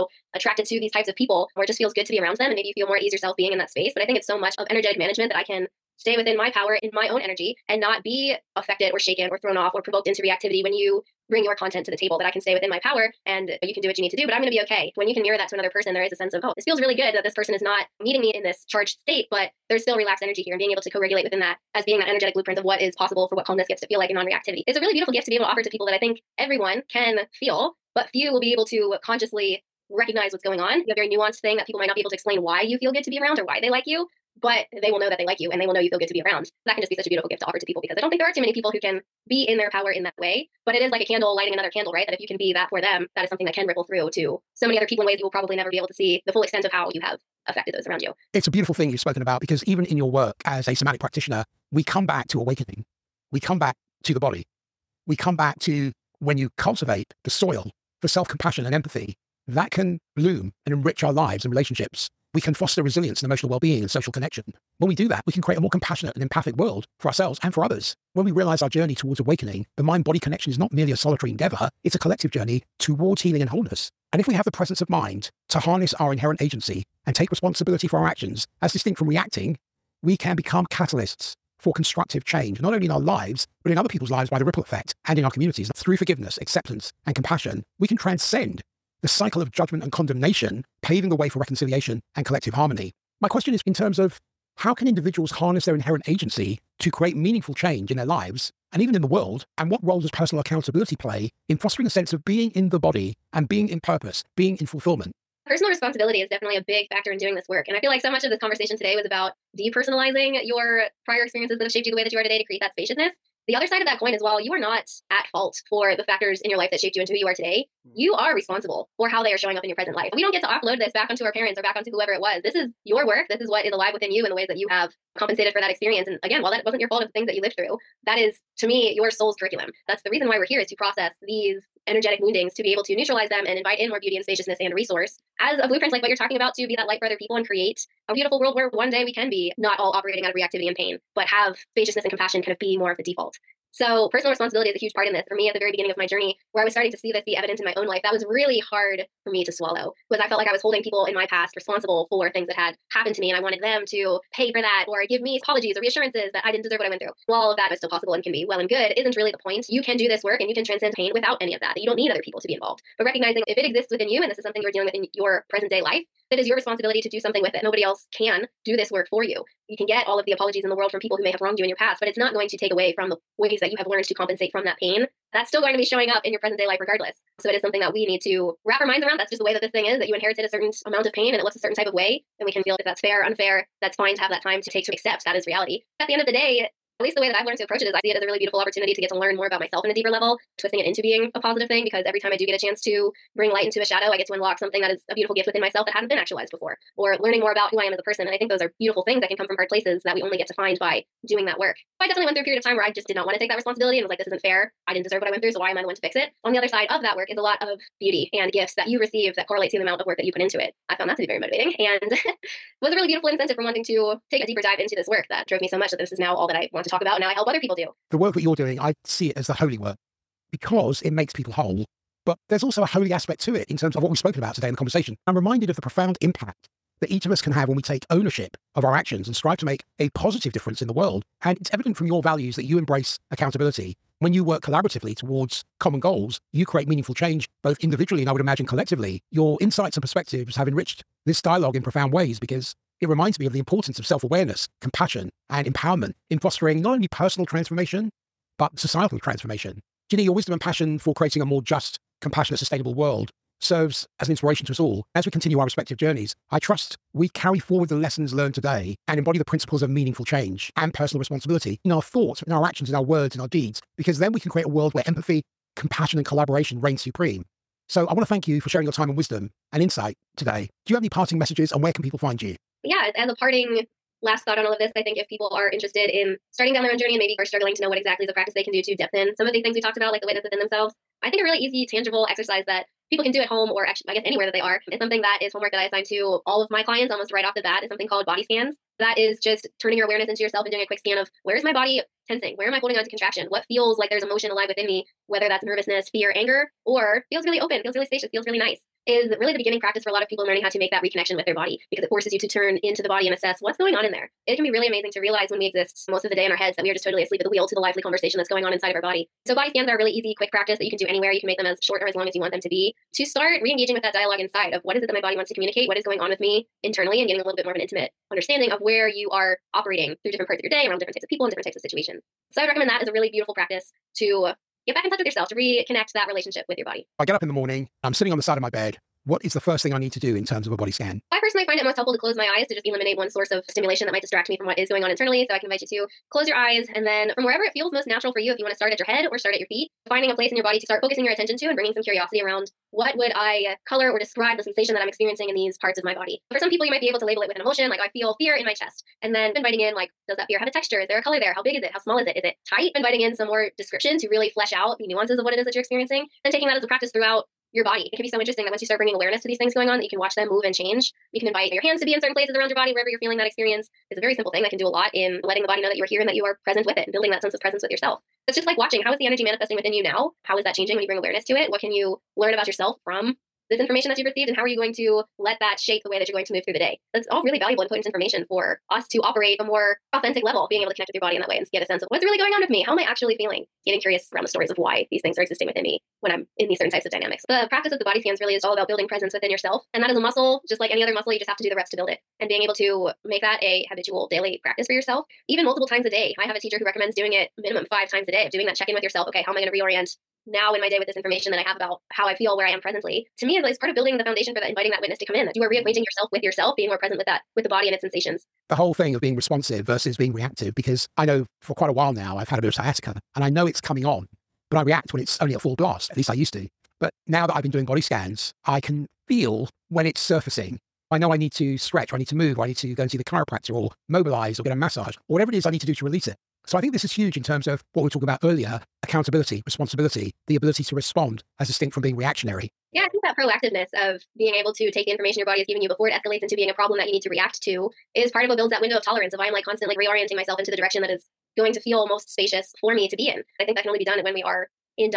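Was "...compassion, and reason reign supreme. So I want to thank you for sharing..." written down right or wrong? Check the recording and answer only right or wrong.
wrong.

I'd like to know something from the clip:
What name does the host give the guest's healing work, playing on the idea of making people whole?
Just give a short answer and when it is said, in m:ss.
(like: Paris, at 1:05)
the holy work, at 3:39.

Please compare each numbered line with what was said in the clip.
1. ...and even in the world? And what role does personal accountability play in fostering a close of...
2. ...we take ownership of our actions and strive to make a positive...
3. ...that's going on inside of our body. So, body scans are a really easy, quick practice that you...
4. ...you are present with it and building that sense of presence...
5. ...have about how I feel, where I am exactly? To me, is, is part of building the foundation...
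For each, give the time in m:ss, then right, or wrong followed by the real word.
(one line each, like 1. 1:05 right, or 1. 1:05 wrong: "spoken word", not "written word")
1. 1:38 wrong: "sense", not "close"
2. 3:47 right
3. 5:08 right
4. 6:06 right
5. 6:41 wrong: "presently", not "exactly".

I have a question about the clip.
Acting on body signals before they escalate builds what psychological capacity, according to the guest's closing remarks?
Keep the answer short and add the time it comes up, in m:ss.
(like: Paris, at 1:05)
window of tolerance, at 7:18.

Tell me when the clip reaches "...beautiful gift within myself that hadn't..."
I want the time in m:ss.
3:15.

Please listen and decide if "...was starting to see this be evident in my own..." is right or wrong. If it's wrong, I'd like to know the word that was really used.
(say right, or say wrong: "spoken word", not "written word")
right.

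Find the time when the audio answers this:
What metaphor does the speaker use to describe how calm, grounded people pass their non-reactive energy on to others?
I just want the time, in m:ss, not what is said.
0:41.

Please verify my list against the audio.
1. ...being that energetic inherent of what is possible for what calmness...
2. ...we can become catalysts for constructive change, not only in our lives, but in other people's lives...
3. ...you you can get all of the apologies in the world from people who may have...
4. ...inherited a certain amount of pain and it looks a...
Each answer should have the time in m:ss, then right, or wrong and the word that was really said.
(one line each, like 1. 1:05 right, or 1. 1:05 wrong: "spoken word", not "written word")
1. 0:21 wrong: "blueprint", not "inherent"
2. 1:20 right
3. 2:49 right
4. 3:00 right.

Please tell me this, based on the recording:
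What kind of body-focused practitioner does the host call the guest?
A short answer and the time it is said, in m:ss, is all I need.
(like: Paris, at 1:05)
somatic practitioner, at 0:50.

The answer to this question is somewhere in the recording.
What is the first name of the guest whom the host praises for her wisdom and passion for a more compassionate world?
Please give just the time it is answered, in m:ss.
4:10.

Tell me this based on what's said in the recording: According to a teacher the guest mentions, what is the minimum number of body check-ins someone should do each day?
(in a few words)
5.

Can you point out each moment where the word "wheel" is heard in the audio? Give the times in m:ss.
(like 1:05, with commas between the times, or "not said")
5:07.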